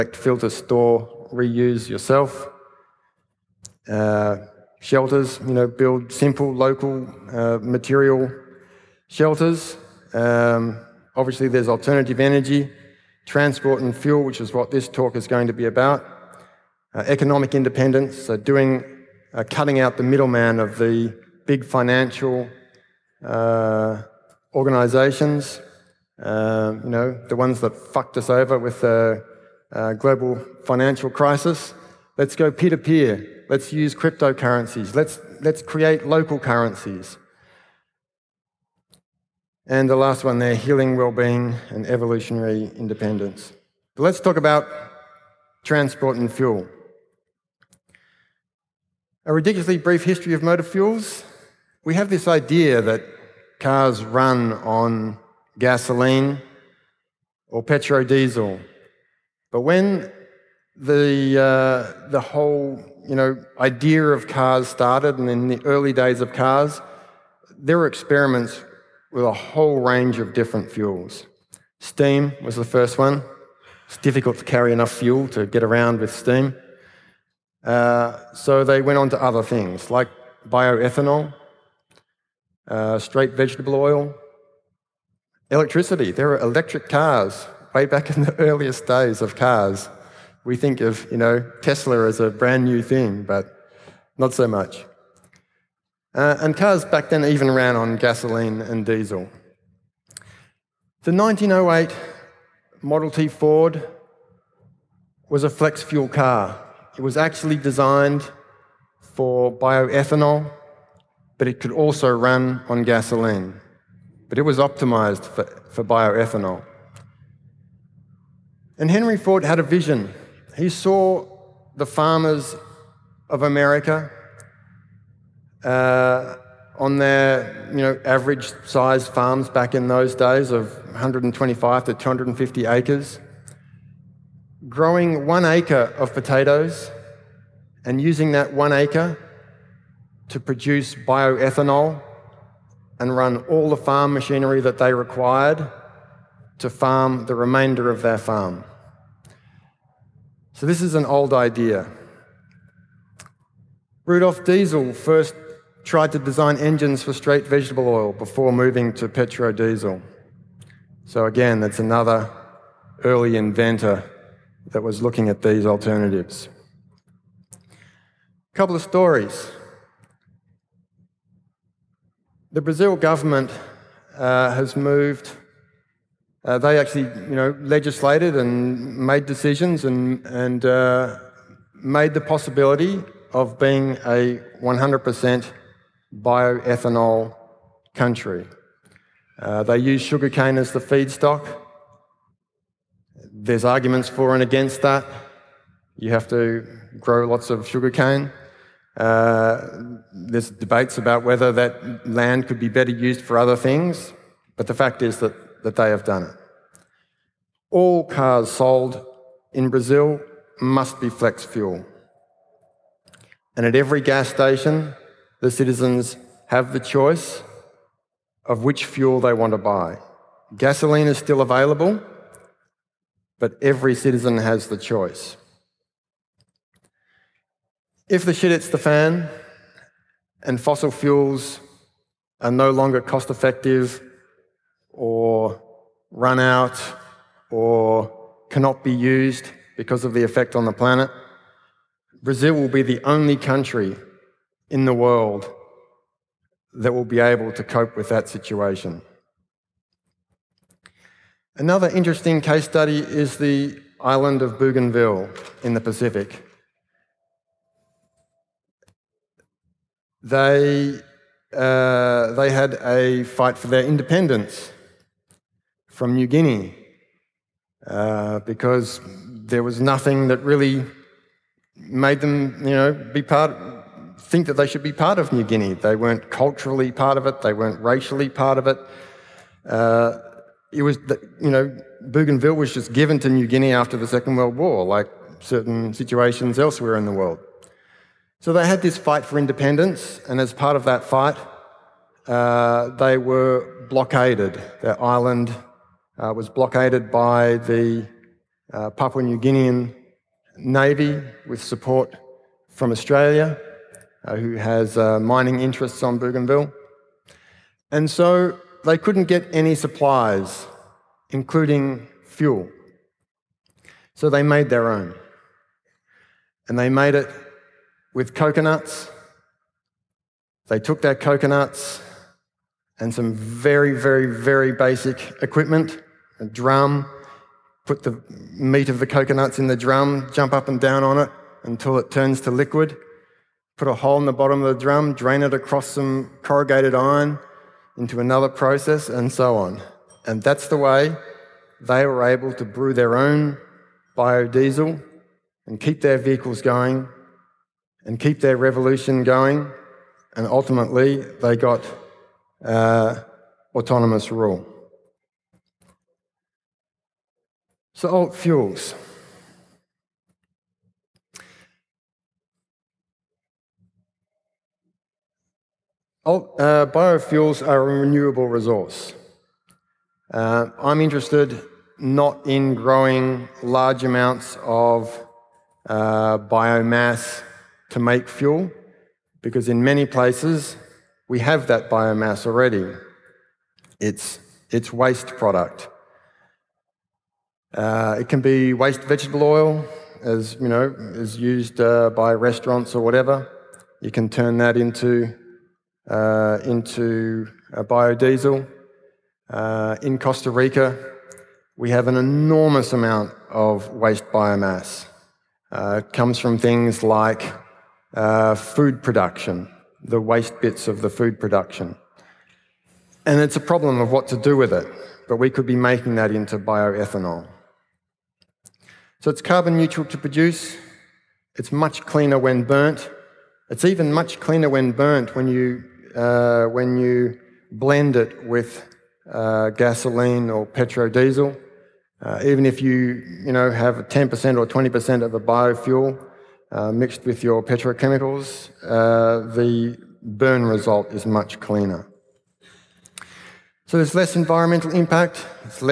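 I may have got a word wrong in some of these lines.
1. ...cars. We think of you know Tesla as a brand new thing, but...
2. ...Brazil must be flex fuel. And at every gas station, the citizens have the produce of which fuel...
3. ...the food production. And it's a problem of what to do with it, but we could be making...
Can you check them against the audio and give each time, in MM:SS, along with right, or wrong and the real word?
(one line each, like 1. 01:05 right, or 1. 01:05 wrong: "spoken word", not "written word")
1. 01:29 right
2. 03:29 wrong: "choice", not "produce"
3. 06:51 right.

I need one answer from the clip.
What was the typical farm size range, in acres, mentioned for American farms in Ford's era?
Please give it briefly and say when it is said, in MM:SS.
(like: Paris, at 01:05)
125 to 250 acres, at 02:10.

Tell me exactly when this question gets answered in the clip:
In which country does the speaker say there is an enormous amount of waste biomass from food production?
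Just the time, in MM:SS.
06:40.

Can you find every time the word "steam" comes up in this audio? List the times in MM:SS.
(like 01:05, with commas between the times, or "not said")
01:11, 01:16.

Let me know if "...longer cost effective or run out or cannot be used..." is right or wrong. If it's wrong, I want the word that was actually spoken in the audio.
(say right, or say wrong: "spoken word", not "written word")
right.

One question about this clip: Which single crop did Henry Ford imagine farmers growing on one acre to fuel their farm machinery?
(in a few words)
potatoes.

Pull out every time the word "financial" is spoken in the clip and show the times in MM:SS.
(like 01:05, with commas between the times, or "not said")
00:21, 00:30.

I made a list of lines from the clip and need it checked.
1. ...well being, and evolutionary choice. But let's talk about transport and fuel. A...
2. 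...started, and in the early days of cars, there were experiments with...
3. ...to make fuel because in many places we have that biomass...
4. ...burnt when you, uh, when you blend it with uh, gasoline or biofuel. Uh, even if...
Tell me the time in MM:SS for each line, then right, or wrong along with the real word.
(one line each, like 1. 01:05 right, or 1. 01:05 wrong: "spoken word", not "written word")
1. 00:40 wrong: "independence", not "choice"
2. 01:04 right
3. 06:17 right
4. 07:04 wrong: "petrodiesel", not "biofuel".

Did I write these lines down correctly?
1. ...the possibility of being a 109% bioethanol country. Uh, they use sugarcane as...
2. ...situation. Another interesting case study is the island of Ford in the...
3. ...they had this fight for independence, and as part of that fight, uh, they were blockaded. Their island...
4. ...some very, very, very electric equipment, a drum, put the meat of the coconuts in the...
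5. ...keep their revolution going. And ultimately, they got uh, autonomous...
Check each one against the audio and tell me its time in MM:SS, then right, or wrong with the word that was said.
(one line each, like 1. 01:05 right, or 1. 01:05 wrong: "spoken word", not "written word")
1. 03:02 wrong: "100", not "109"
2. 04:08 wrong: "Bougainville", not "Ford"
3. 04:48 right
4. 05:23 wrong: "basic", not "electric"
5. 05:48 right.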